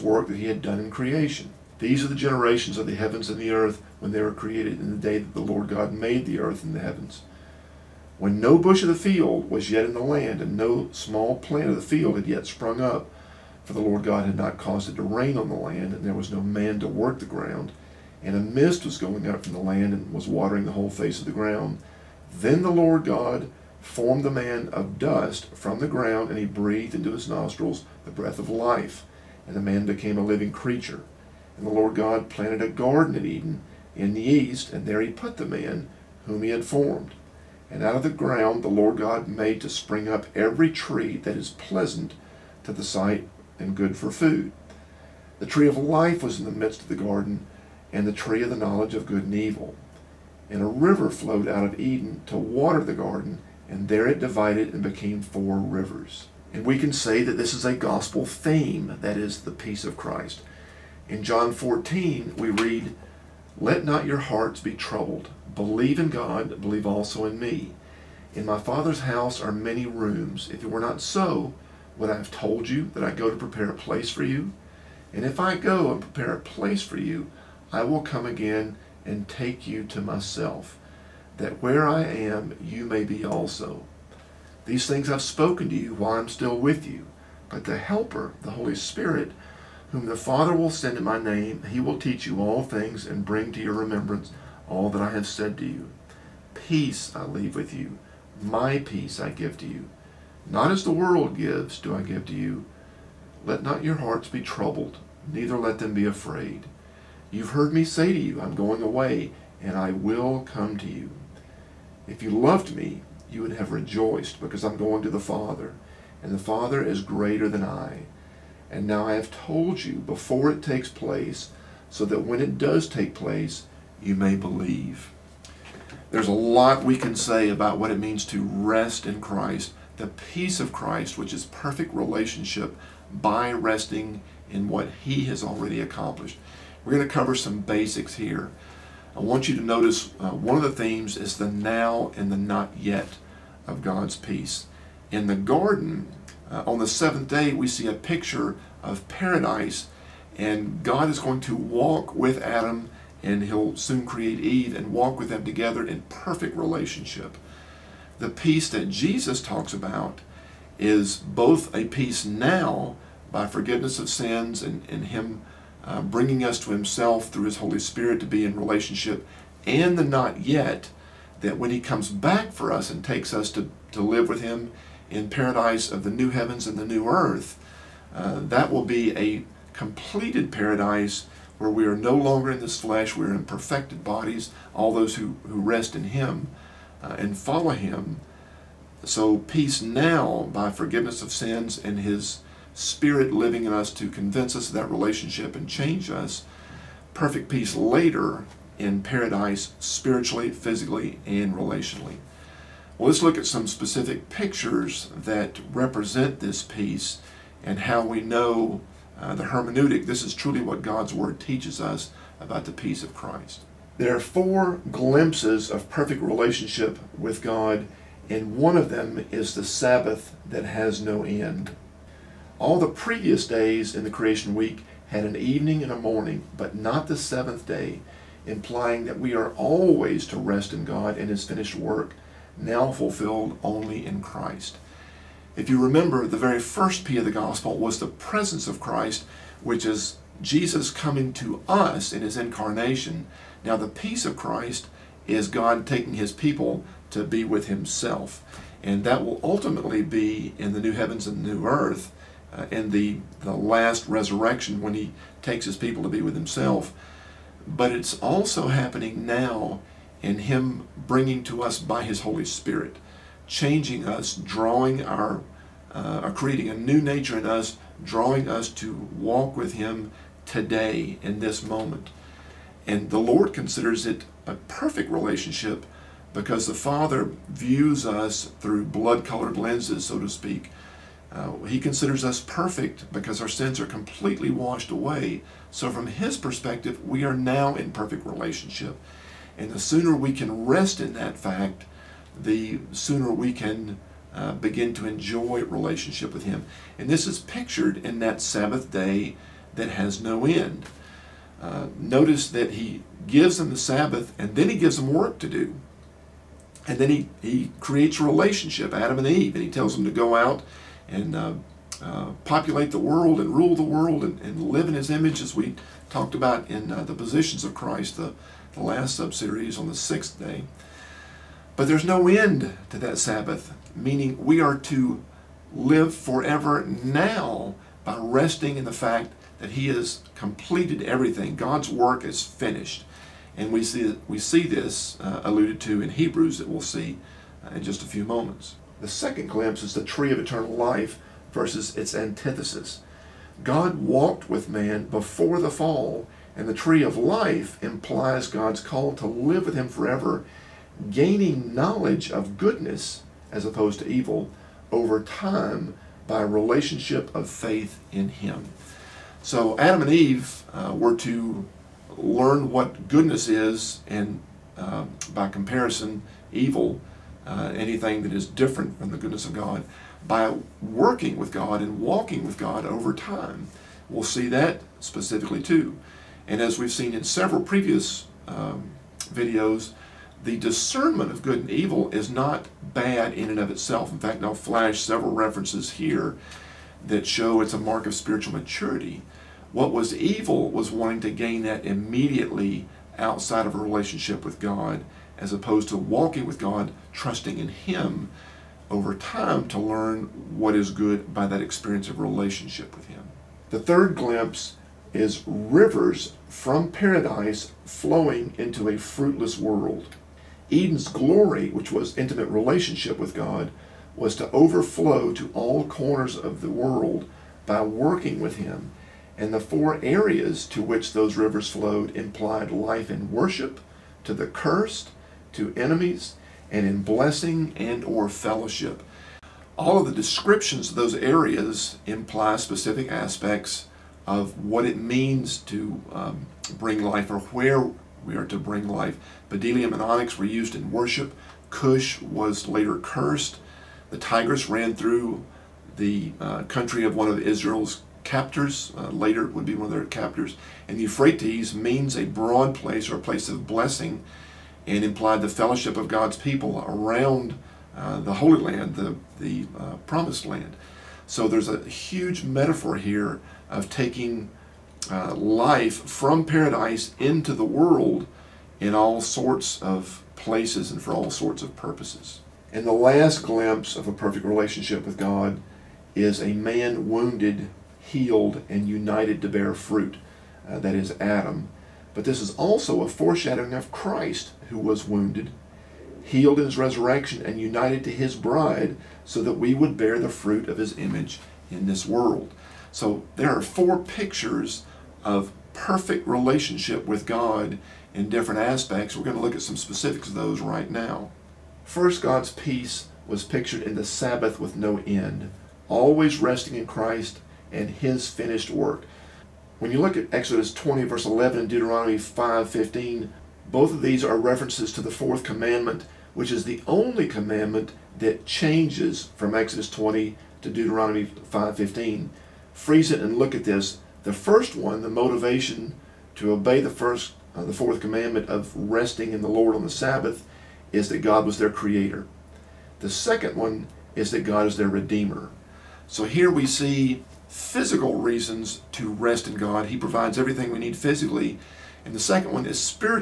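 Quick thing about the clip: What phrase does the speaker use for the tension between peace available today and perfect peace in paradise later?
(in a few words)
The now and the not yet.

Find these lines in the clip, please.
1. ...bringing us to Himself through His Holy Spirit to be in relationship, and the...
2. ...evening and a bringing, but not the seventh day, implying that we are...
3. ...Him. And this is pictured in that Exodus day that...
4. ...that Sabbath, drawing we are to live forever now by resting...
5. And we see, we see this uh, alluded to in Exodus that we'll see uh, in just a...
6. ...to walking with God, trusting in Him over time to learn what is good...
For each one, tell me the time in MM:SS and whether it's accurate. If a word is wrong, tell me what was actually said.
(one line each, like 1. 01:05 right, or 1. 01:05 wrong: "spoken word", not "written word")
1. 02:46 right
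2. 03:45 wrong: "morning", not "bringing"
3. 04:56 wrong: "Sabbath", not "Exodus"
4. 05:22 wrong: "meaning", not "drawing"
5. 05:33 wrong: "Hebrews", not "Exodus"
6. 06:35 right.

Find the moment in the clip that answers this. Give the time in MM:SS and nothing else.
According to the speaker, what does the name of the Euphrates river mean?
07:32.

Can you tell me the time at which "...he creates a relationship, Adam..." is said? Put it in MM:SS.
05:07.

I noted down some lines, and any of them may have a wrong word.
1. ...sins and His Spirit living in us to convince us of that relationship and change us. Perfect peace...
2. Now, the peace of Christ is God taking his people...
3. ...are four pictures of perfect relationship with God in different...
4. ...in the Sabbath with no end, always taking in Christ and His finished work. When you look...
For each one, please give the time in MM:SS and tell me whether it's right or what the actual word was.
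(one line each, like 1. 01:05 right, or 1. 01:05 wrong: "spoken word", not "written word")
1. 03:11 right
2. 04:03 right
3. 08:13 right
4. 08:23 wrong: "resting", not "taking".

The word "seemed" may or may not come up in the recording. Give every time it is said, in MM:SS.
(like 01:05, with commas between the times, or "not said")
not said.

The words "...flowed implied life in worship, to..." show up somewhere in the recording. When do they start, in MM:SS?
07:01.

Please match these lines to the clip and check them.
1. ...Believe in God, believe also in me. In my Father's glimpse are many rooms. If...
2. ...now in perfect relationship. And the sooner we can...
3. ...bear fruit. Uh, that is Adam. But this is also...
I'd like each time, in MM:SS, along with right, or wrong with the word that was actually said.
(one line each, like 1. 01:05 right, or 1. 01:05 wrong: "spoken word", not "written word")
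1. 01:05 wrong: "house", not "glimpse"
2. 04:47 right
3. 07:59 right.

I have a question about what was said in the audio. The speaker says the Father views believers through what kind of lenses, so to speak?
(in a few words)
Blood colored lenses.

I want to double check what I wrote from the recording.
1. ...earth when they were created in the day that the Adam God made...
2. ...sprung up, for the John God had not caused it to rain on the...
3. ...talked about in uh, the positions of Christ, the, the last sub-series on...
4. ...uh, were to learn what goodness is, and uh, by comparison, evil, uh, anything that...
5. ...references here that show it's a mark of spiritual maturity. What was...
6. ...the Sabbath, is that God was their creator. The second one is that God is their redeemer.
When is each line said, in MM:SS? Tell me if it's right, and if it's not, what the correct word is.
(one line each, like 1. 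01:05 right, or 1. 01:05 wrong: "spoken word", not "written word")
1. 00:03 wrong: "Lord", not "Adam"
2. 00:12 wrong: "Lord", not "John"
3. 05:16 right
4. 06:00 right
5. 06:25 right
6. 08:49 right.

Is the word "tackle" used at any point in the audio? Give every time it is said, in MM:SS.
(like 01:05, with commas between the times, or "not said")
not said.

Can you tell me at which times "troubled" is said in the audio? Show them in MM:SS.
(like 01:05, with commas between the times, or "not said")
01:04, 01:44.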